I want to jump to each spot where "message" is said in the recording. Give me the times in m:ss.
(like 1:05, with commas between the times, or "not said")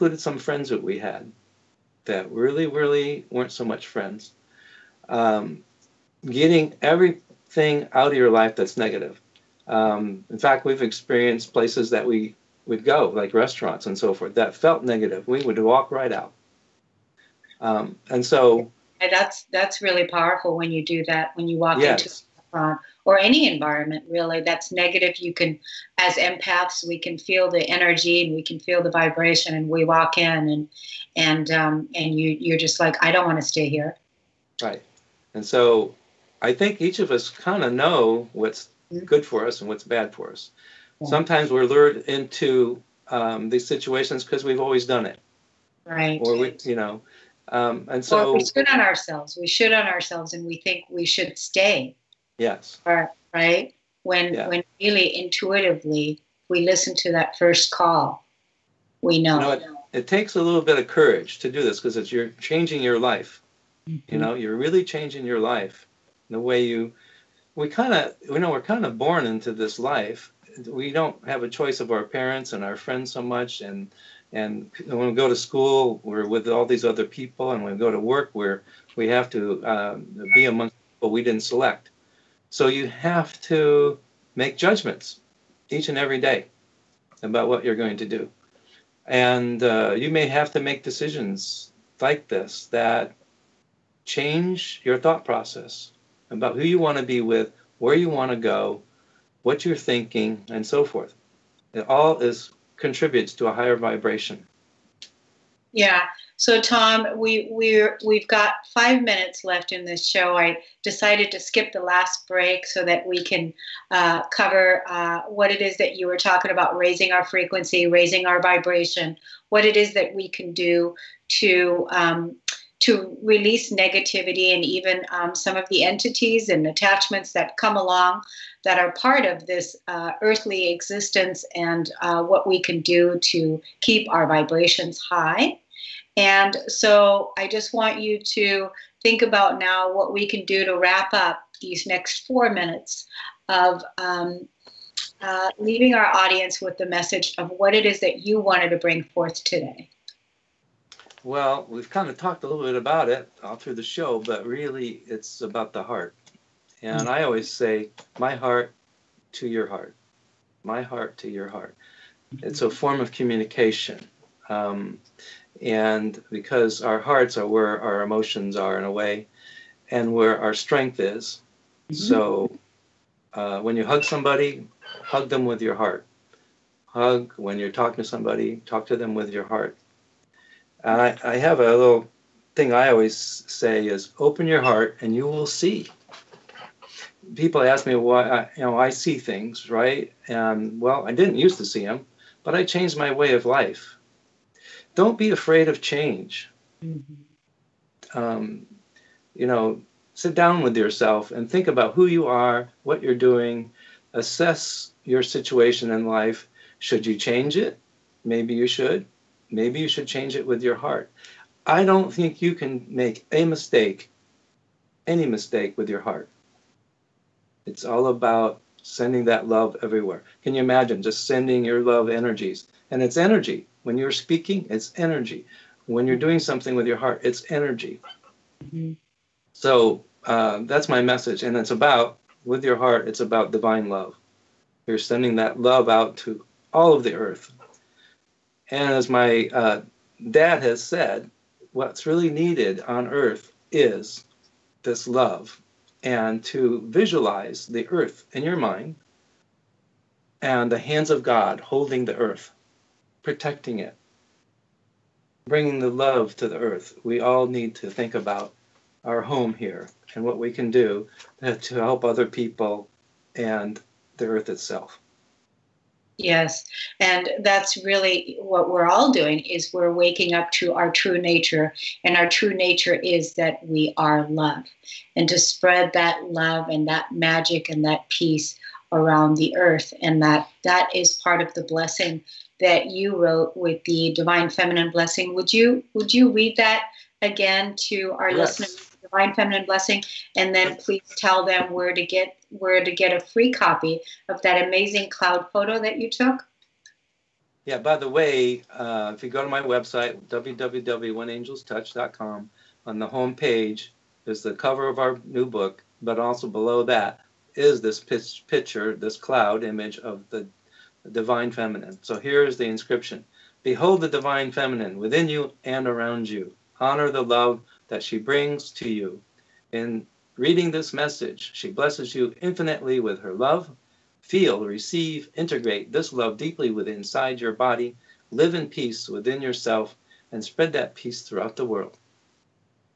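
2:26, 3:51, 5:20.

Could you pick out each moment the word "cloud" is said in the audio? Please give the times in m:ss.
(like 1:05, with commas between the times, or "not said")
4:55, 5:09.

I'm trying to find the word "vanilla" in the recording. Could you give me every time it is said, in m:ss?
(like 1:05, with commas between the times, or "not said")
not said.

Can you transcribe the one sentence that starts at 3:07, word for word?
People ask me why I, you know I see things, right?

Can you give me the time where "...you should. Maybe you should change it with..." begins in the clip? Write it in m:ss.
3:28.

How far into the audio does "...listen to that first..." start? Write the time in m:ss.
0:56.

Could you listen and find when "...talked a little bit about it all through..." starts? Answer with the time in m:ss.
2:32.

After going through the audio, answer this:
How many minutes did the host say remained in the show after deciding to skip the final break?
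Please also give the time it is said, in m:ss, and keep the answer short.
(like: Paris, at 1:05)
5, at 1:48.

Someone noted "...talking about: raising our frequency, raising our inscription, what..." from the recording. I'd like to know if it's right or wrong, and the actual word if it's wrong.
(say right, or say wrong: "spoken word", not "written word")
wrong: "vibration", not "inscription".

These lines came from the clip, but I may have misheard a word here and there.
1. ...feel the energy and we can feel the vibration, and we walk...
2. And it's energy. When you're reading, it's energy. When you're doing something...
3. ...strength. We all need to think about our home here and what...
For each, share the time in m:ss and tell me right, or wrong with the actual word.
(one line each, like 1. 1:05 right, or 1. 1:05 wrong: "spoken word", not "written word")
1. 0:27 right
2. 3:42 wrong: "speaking", not "reading"
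3. 4:16 wrong: "earth", not "strength".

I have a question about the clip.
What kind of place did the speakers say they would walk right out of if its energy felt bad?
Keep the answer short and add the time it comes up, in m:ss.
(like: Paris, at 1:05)
Restaurants, at 0:13.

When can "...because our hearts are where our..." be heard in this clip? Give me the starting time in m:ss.
2:46.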